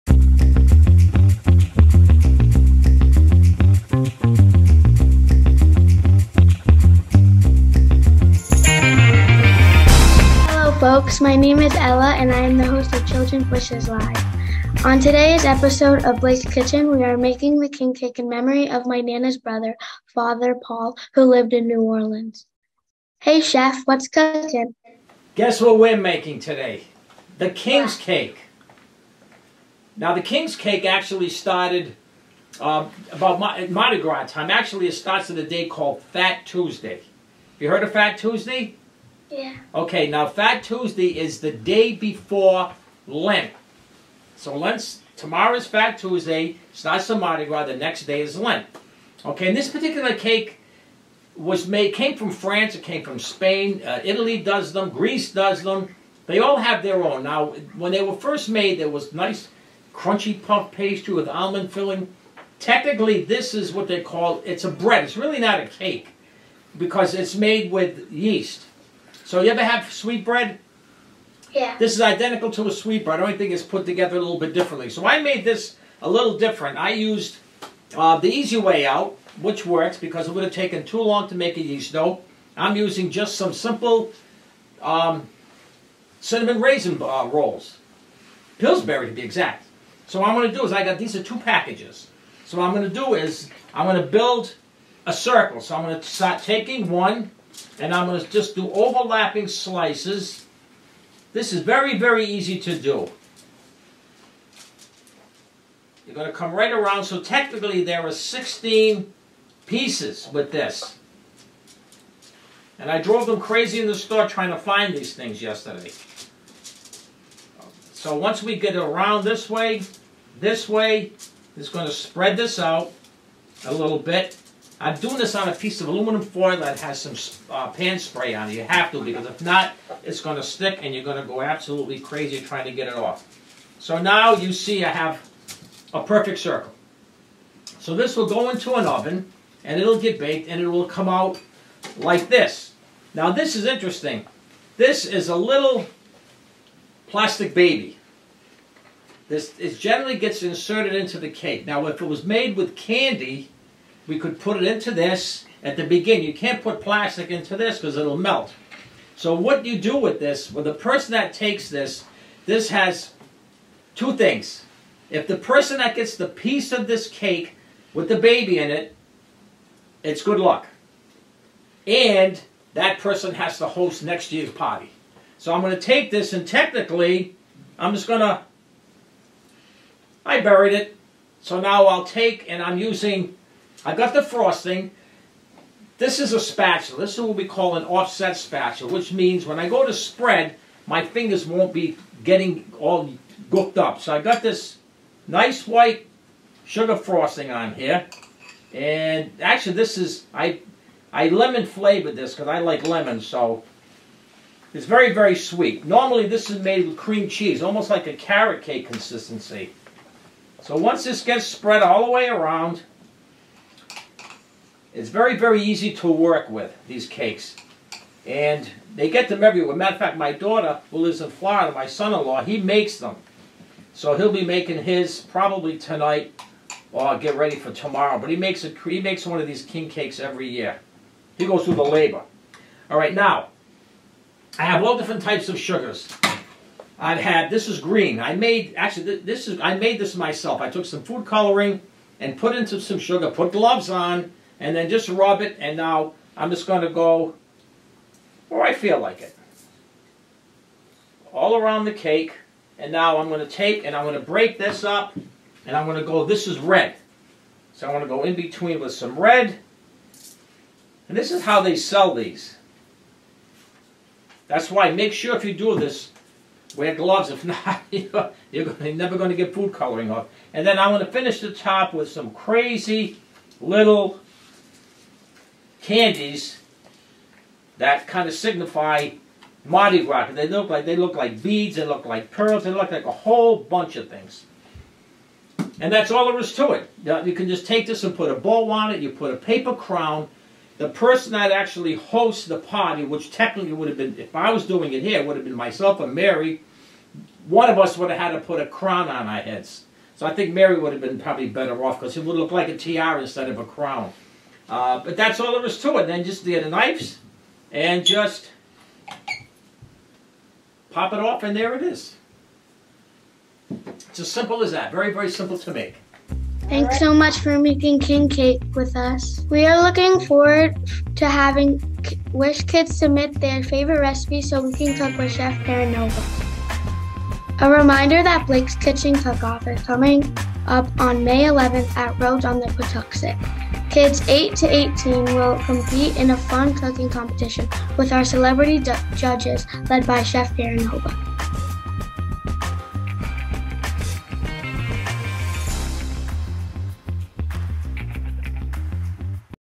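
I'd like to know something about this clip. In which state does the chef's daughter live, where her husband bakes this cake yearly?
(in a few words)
Florida.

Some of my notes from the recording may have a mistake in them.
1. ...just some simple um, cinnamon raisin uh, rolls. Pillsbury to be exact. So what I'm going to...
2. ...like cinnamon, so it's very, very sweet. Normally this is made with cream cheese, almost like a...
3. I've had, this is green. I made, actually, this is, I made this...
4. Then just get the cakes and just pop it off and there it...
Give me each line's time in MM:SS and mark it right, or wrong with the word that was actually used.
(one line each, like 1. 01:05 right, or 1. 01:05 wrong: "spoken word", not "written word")
1. 01:23 right
2. 03:22 wrong: "lemon", not "cinnamon"
3. 03:56 right
4. 05:06 wrong: "knives", not "cakes".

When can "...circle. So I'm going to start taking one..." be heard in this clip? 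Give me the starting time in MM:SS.
01:35.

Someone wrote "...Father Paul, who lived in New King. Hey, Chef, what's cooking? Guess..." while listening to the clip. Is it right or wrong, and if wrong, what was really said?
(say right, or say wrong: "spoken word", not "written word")
wrong: "Orleans", not "King".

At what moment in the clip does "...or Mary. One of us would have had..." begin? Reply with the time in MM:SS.
04:55.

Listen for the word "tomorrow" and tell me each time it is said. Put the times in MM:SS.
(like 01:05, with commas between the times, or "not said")
00:45, 03:47.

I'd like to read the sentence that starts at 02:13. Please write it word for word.
So now you see I have a perfect circle.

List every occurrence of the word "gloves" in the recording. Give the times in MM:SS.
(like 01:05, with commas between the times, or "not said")
04:03, 04:26.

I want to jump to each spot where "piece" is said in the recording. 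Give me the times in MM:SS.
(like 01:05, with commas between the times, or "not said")
01:49, 02:05, 02:46.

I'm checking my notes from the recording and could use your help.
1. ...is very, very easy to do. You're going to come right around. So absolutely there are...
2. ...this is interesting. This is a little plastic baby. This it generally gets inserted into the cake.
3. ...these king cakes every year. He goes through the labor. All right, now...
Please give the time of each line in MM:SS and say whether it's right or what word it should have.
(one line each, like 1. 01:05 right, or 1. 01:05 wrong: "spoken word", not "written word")
1. 01:41 wrong: "technically", not "absolutely"
2. 02:23 right
3. 03:49 right.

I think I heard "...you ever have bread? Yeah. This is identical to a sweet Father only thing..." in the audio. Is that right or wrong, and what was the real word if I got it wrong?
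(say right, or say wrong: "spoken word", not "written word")
wrong: "The", not "Father".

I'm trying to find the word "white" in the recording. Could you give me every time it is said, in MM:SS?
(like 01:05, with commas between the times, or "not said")
03:15.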